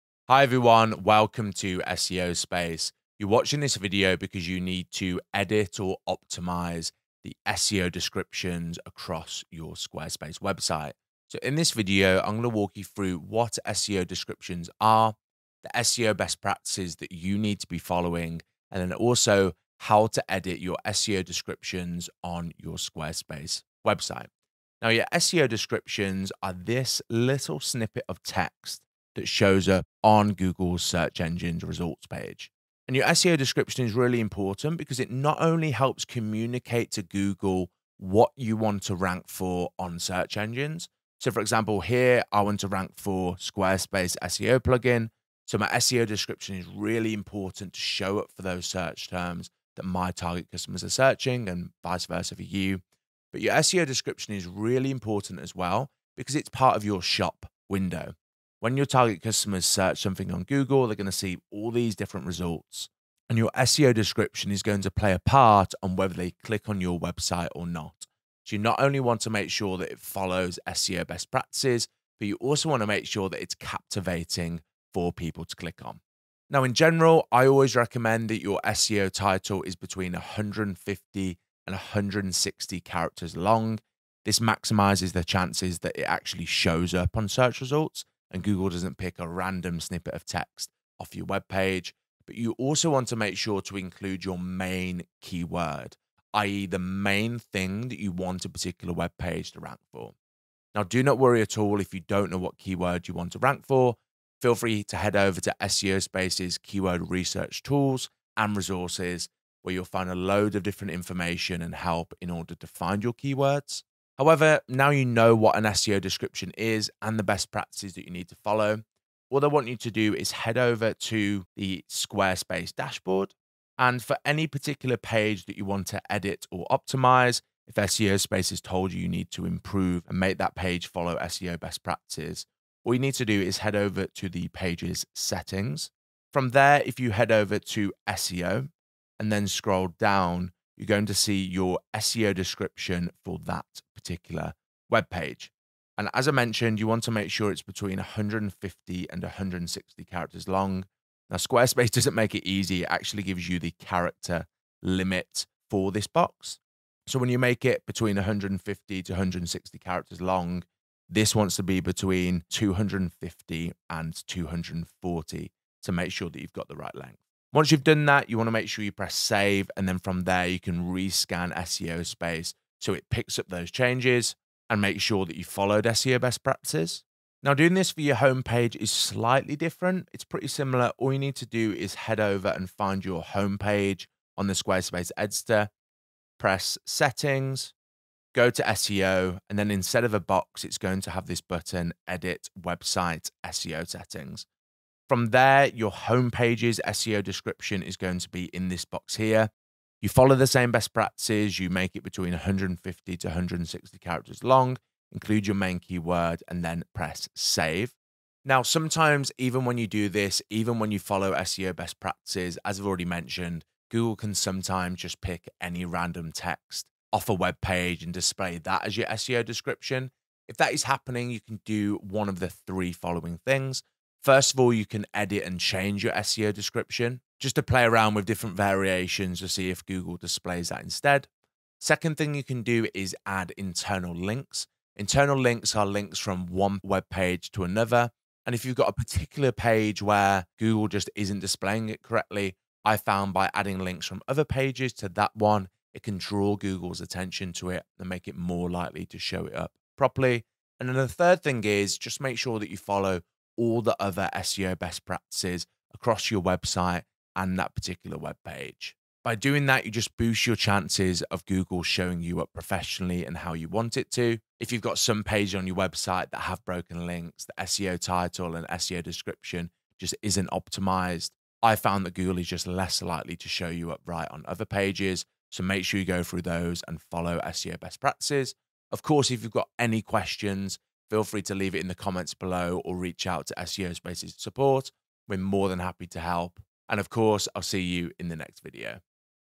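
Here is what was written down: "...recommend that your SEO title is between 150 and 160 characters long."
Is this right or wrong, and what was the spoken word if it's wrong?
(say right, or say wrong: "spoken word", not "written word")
right.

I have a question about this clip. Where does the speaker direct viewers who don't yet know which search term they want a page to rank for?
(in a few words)
Keyword research tools.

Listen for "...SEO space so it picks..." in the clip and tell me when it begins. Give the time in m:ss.
2:51.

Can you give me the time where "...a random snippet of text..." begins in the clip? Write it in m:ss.
1:29.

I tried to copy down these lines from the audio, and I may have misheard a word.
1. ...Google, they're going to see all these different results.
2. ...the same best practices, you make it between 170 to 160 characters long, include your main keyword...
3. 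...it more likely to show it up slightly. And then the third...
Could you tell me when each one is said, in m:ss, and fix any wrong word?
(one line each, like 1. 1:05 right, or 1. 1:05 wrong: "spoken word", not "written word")
1. 1:00 right
2. 3:20 wrong: "150", not "170"
3. 4:08 wrong: "properly", not "slightly".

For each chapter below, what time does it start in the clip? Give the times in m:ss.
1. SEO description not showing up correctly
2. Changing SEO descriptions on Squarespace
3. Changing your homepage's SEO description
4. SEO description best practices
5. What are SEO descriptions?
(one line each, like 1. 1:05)
1. 3:28
2. 2:01
3. 2:57
4. 1:16
5. 0:25.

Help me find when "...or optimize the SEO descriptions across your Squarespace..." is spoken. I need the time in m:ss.
0:05.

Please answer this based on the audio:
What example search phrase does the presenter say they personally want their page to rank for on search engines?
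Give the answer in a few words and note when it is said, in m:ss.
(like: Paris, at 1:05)
Squarespace SEO plugin, at 0:43.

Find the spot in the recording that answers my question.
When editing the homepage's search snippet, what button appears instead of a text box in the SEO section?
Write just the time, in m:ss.
3:12.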